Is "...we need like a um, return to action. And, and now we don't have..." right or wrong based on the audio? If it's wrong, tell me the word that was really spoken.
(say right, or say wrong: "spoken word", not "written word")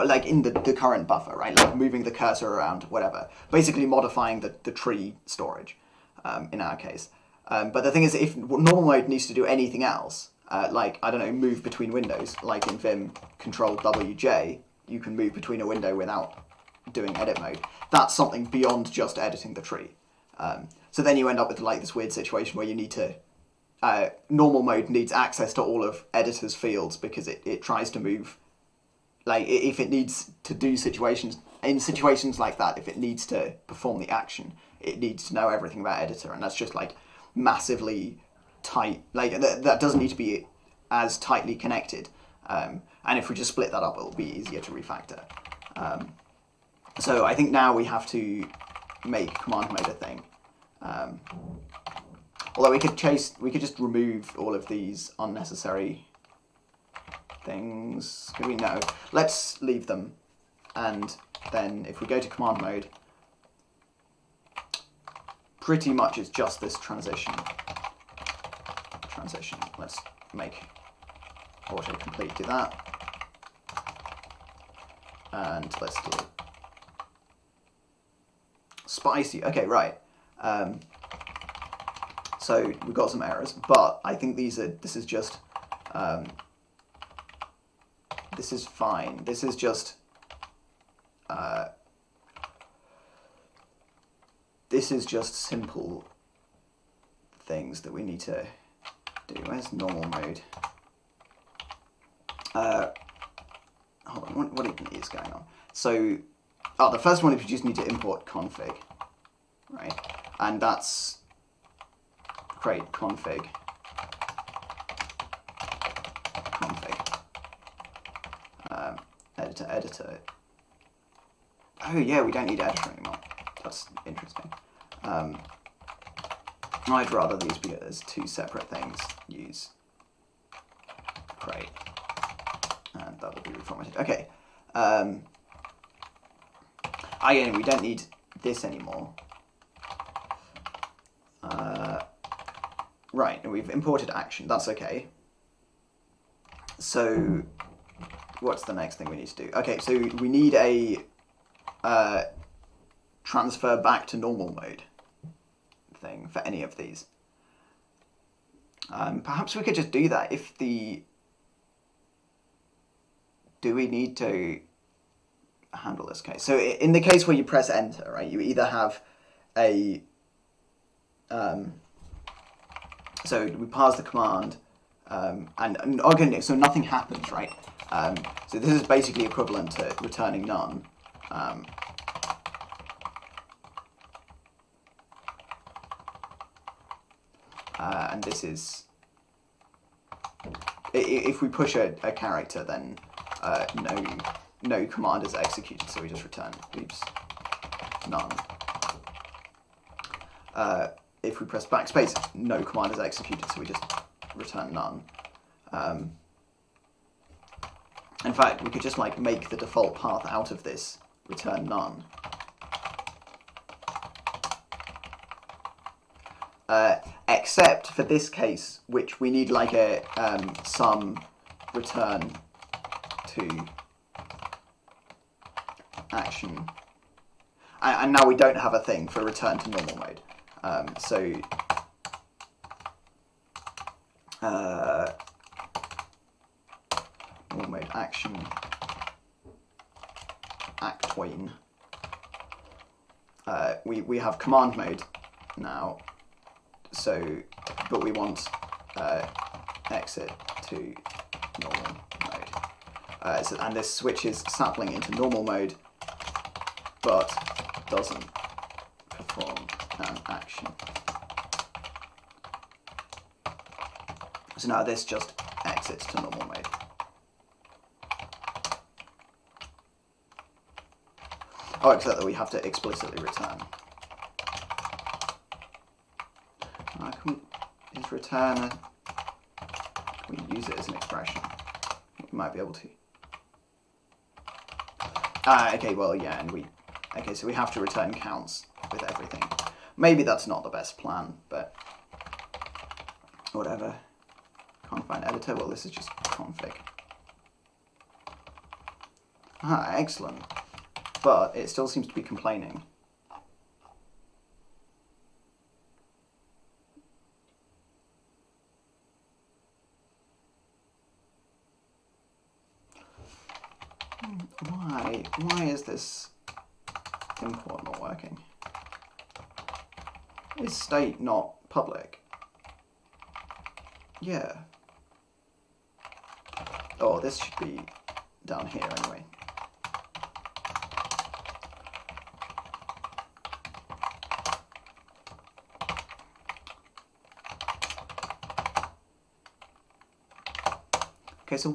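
right.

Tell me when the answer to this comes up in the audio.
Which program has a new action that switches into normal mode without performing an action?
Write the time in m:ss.
4:14.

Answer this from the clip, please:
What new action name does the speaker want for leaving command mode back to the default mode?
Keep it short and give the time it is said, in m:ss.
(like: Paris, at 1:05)
exit to normal, at 4:09.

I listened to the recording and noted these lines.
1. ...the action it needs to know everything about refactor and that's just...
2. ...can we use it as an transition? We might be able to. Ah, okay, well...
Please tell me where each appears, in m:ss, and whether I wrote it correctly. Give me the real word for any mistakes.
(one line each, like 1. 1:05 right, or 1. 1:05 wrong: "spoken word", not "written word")
1. 0:33 wrong: "editor", not "refactor"
2. 4:40 wrong: "expression", not "transition".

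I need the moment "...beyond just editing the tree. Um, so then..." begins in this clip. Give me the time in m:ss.
0:18.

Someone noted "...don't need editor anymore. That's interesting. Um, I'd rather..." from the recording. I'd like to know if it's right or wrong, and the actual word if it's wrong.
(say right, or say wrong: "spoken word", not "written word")
right.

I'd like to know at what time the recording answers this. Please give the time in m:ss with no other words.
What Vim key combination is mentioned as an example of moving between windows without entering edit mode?
0:13.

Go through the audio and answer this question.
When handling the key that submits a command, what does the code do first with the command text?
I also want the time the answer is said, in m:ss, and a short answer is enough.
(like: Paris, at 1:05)
parse the command, at 2:53.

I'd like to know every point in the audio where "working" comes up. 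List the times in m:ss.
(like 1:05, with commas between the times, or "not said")
5:17.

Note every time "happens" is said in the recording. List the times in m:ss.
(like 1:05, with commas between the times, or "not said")
2:56.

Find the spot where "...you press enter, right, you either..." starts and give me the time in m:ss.
2:47.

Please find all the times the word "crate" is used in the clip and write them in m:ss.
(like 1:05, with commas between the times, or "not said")
1:52.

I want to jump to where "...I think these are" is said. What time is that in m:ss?
1:24.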